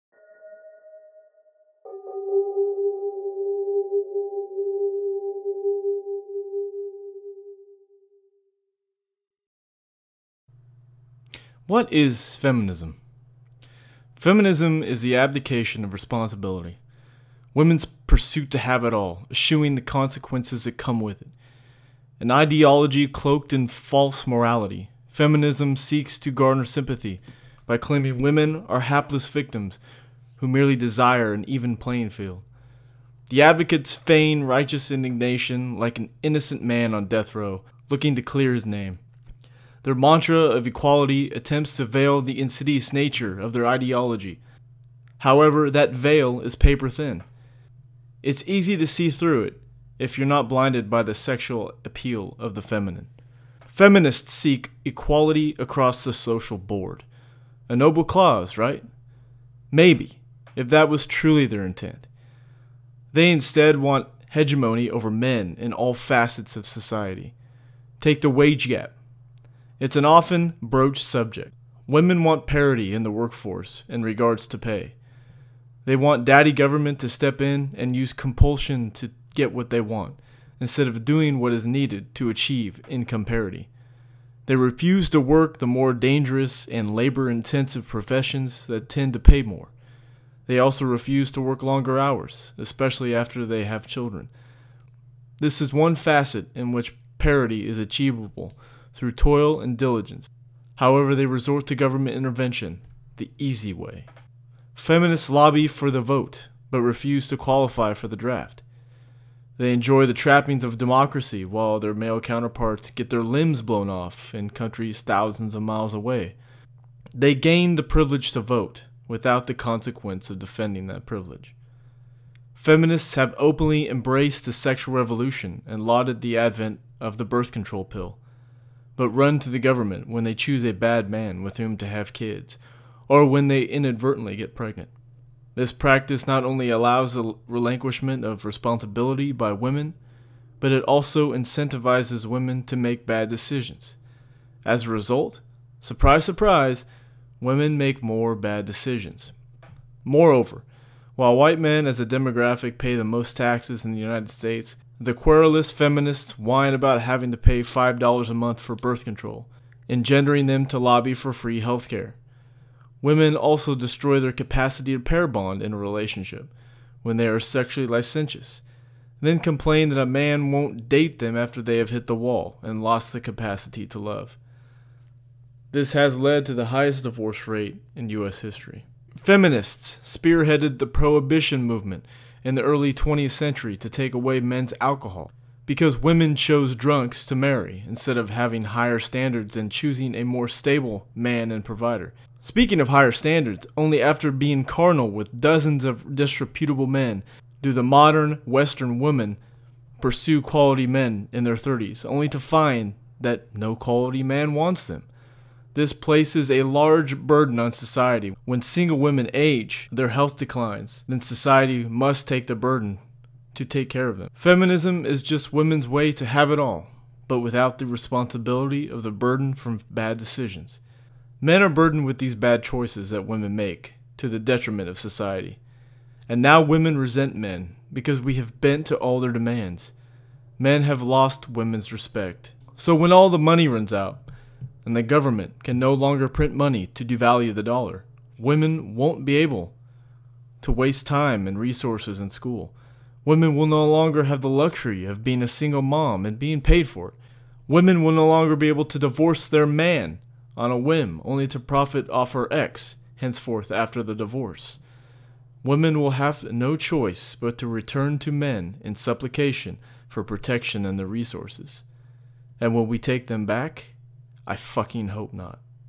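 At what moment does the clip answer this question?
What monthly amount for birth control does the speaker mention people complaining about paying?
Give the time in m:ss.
2:37.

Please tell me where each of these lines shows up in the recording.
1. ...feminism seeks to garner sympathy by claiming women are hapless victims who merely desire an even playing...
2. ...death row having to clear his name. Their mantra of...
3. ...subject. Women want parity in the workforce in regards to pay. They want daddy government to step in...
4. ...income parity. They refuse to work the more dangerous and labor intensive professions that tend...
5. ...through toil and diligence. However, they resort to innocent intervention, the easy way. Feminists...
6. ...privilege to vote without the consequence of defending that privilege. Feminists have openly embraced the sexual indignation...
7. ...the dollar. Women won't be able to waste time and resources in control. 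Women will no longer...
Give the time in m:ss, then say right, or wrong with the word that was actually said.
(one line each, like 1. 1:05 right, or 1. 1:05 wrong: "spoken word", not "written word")
1. 0:25 right
2. 0:37 wrong: "looking", not "having"
3. 1:11 right
4. 1:22 right
5. 1:38 wrong: "government", not "innocent"
6. 1:57 wrong: "revolution", not "indignation"
7. 3:57 wrong: "school", not "control".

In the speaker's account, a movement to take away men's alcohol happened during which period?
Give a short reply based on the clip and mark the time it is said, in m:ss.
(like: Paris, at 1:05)
early 20th century, at 3:02.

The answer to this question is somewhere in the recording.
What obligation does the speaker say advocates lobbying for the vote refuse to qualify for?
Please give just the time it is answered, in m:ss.
1:48.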